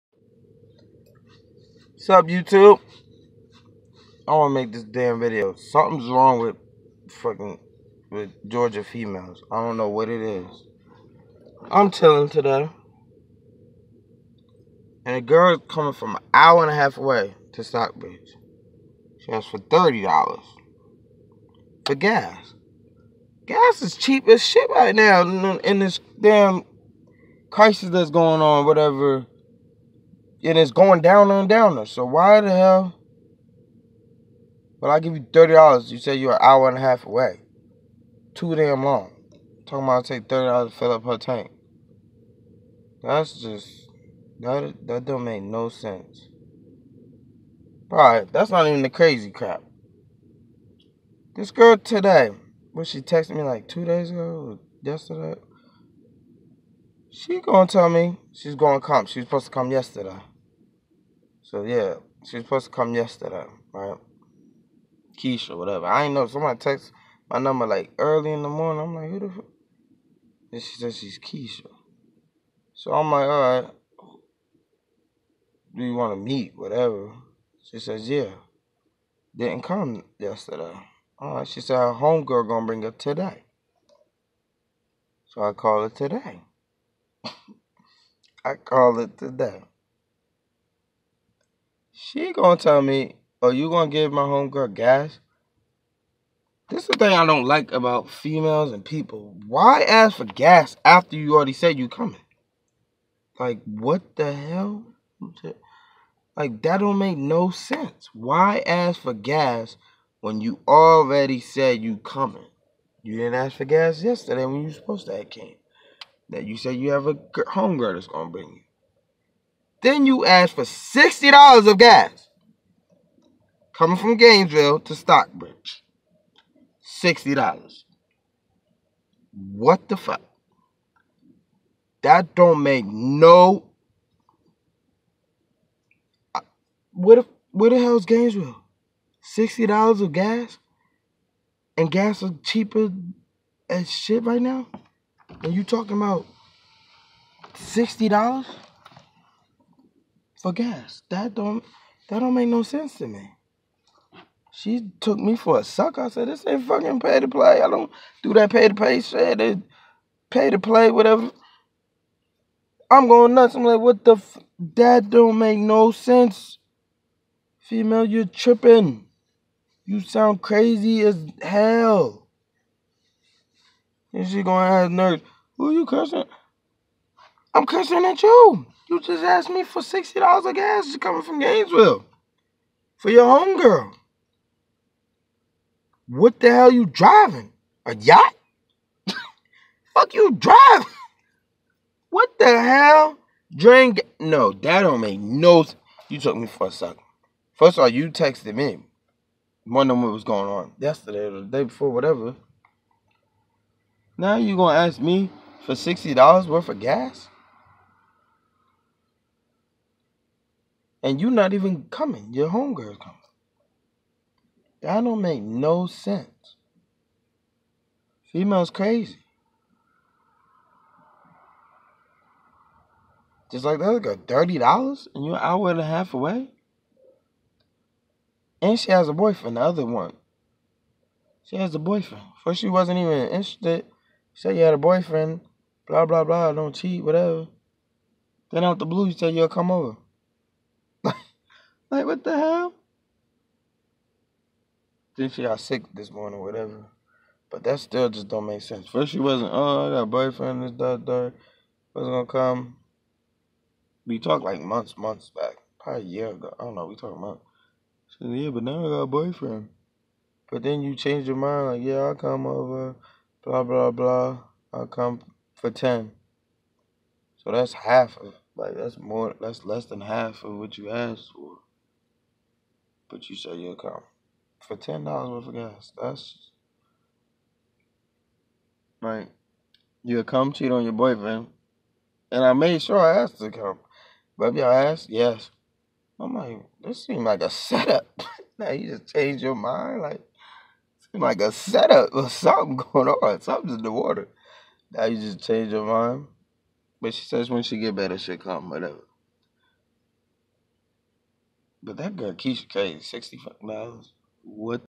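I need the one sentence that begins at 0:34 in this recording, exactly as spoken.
But I give you thirty dollars.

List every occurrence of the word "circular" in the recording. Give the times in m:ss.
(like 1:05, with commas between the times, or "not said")
not said.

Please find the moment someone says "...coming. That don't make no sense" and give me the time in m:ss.
3:32.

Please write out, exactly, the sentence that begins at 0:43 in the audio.
That's just that that don't make no sense.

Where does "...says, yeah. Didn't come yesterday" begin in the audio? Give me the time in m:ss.
1:17.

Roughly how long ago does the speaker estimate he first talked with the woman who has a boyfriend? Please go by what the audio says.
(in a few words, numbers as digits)
A year ago.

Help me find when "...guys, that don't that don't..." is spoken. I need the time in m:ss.
2:30.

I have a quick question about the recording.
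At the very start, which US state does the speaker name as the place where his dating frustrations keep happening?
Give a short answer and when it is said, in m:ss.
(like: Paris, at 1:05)
Georgia, at 0:08.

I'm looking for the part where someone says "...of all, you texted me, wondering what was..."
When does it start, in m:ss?
3:17.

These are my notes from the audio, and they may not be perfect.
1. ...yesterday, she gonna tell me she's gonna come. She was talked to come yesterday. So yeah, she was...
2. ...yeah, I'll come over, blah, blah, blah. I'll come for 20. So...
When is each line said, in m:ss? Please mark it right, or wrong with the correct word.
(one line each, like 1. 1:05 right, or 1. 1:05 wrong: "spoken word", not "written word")
1. 0:54 wrong: "supposed", not "talked"
2. 4:21 wrong: "10", not "20".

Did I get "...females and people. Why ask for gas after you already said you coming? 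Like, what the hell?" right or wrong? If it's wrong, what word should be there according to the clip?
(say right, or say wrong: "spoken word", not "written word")
right.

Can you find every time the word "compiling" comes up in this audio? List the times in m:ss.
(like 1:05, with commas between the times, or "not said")
not said.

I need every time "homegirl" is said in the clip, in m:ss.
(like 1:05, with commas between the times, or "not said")
1:21, 1:34, 1:57, 3:03, 3:32.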